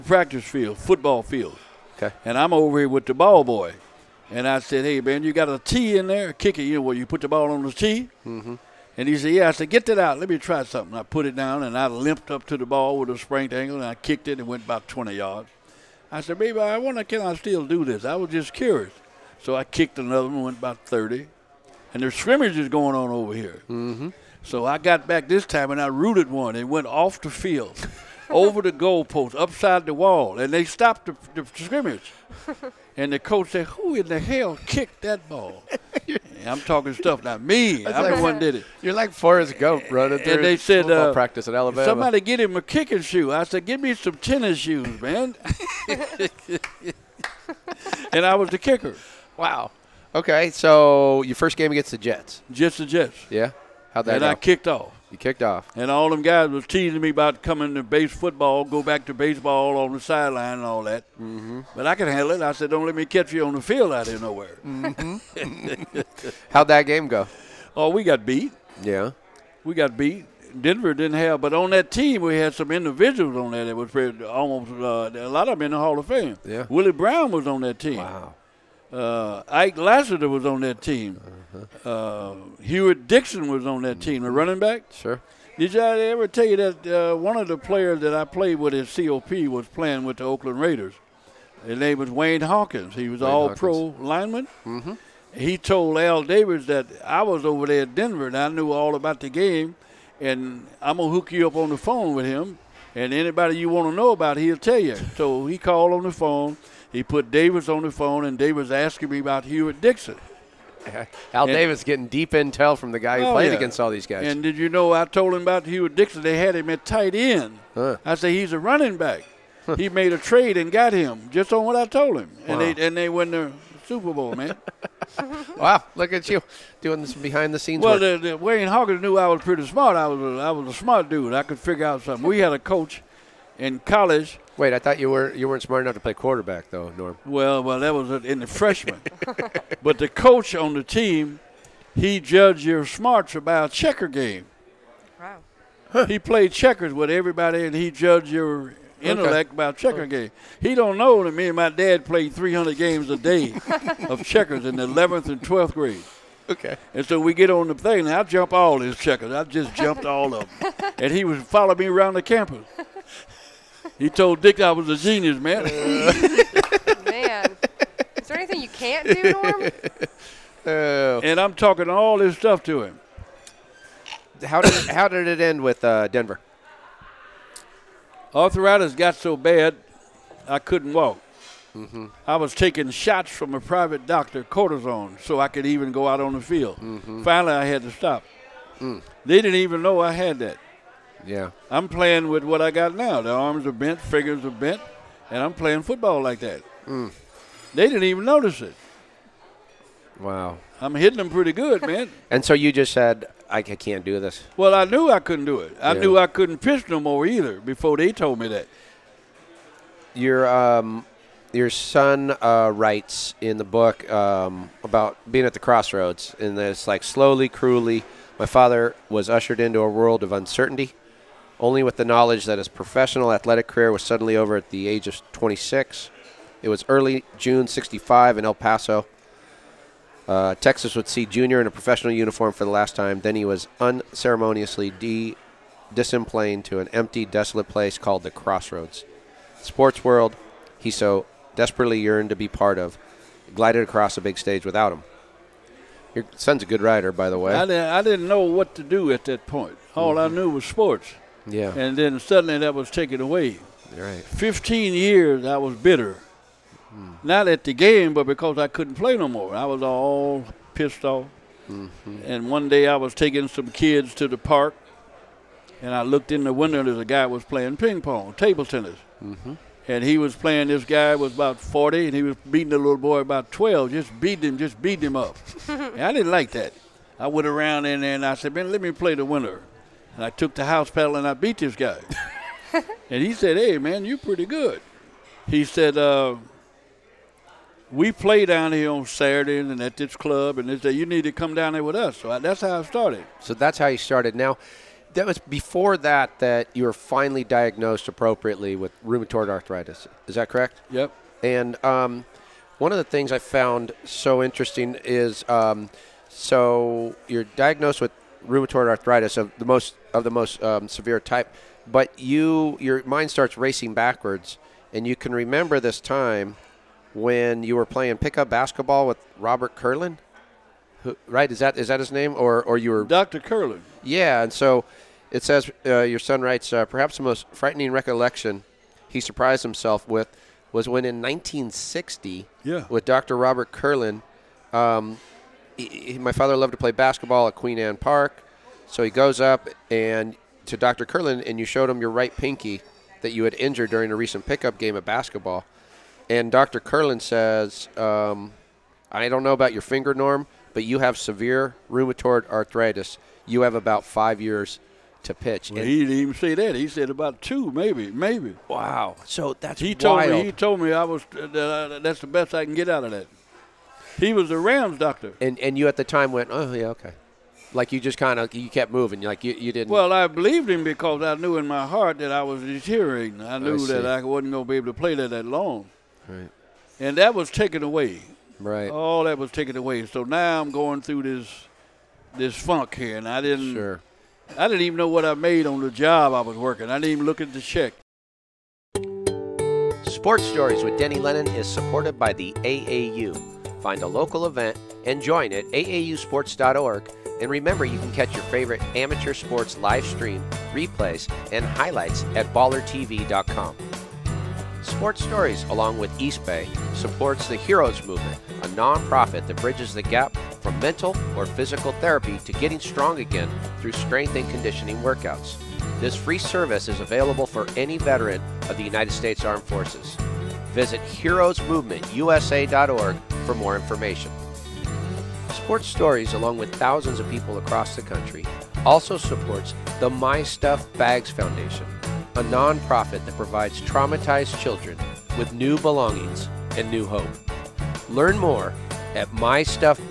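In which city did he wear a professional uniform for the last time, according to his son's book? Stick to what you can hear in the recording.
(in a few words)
El Paso.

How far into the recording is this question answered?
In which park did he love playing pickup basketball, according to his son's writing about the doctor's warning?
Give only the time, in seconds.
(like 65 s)
337 s.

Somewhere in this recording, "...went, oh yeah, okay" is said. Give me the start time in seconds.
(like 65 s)
366 s.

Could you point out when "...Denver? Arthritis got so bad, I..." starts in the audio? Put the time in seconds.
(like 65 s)
176 s.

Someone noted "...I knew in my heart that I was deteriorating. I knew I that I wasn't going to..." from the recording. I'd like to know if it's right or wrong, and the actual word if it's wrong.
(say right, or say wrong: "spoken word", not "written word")
right.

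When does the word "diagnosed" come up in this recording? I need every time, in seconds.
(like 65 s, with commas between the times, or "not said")
297 s, 307 s.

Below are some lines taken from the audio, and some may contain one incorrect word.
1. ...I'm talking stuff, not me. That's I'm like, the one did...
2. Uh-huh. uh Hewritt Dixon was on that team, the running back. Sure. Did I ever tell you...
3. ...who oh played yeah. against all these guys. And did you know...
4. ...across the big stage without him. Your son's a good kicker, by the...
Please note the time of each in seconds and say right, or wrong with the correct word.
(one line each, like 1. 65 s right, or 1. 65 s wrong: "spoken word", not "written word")
1. 36 s right
2. 81 s right
3. 113 s right
4. 243 s wrong: "writer", not "kicker".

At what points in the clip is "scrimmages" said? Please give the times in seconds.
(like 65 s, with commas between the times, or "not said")
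22 s, 31 s.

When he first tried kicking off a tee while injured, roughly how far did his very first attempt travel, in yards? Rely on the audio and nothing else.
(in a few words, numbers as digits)
20 yards.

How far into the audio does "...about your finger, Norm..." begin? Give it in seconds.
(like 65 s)
349 s.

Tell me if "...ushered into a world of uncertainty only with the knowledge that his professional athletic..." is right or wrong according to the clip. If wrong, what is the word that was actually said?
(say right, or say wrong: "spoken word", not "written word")
right.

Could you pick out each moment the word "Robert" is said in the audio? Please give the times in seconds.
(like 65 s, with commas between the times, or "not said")
319 s, 333 s.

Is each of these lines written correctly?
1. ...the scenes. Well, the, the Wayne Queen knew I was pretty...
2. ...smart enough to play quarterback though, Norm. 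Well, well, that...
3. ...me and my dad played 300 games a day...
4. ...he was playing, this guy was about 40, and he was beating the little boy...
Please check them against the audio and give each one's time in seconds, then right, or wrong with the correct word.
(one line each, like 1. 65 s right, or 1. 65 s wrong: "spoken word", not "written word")
1. 127 s wrong: "Hawkins", not "Queen"
2. 135 s right
3. 151 s right
4. 270 s right.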